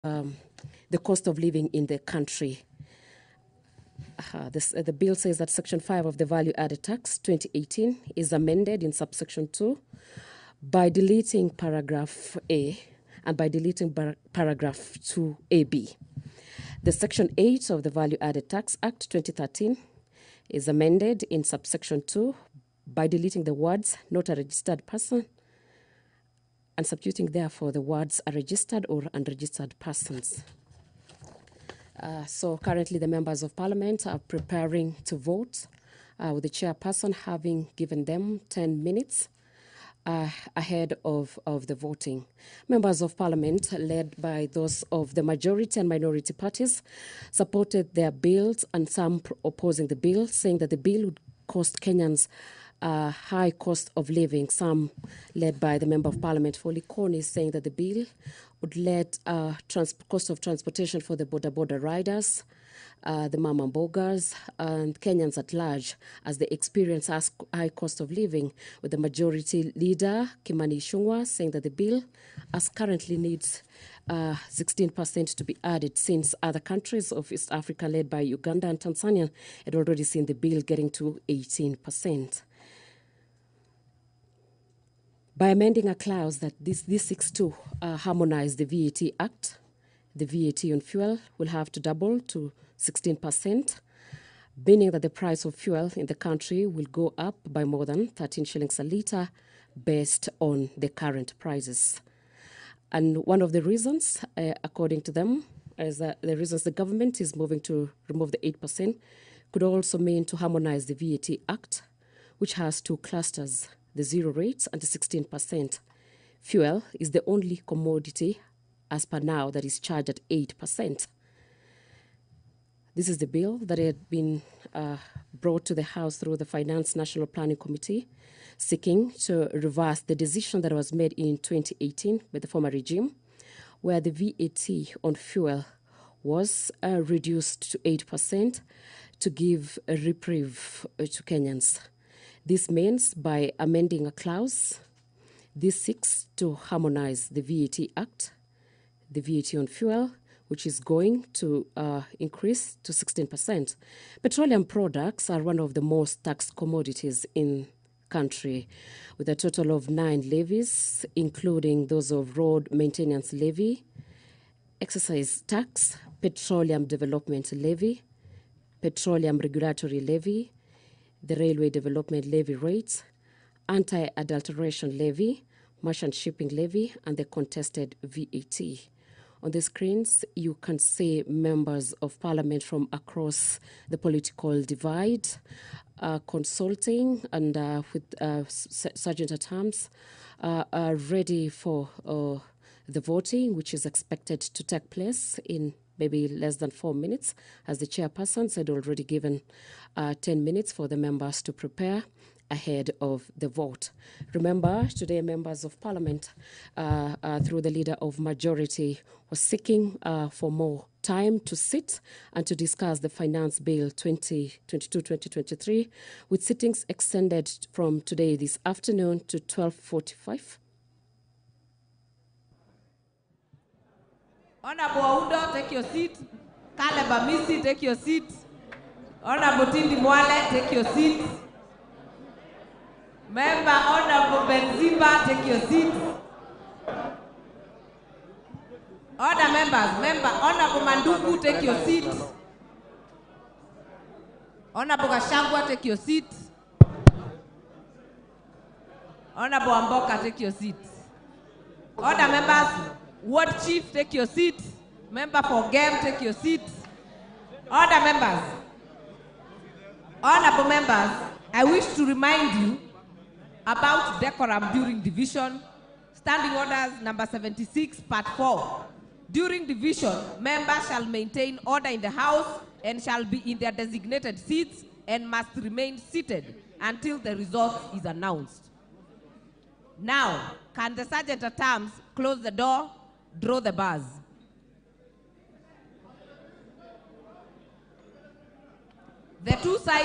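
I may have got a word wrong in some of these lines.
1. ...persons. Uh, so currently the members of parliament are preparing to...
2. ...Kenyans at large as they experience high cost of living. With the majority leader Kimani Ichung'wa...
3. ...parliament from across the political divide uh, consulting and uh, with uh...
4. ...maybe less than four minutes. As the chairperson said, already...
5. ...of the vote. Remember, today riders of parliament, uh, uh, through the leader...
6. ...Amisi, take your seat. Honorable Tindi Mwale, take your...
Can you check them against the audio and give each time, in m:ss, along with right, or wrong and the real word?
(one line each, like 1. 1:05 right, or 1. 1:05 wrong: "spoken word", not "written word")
1. 0:29 right
2. 1:05 right
3. 3:02 right
4. 3:16 right
5. 3:22 wrong: "members", not "riders"
6. 3:47 right.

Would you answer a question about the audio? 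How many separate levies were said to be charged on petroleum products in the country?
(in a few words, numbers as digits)
9.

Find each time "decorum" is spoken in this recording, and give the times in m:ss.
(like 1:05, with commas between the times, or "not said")
4:24.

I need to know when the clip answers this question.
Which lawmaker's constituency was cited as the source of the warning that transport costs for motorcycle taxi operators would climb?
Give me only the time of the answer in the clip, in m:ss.
0:56.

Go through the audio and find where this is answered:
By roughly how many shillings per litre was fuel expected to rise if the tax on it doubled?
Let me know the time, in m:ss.
1:38.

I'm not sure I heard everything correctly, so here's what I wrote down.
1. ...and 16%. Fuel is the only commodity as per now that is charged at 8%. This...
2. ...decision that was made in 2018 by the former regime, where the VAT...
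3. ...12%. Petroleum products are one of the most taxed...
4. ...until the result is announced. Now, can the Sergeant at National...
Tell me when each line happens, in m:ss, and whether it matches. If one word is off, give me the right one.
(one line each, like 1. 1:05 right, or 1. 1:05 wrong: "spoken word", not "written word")
1. 1:54 right
2. 2:10 right
3. 2:32 wrong: "16", not "12"
4. 4:36 wrong: "Arms", not "National".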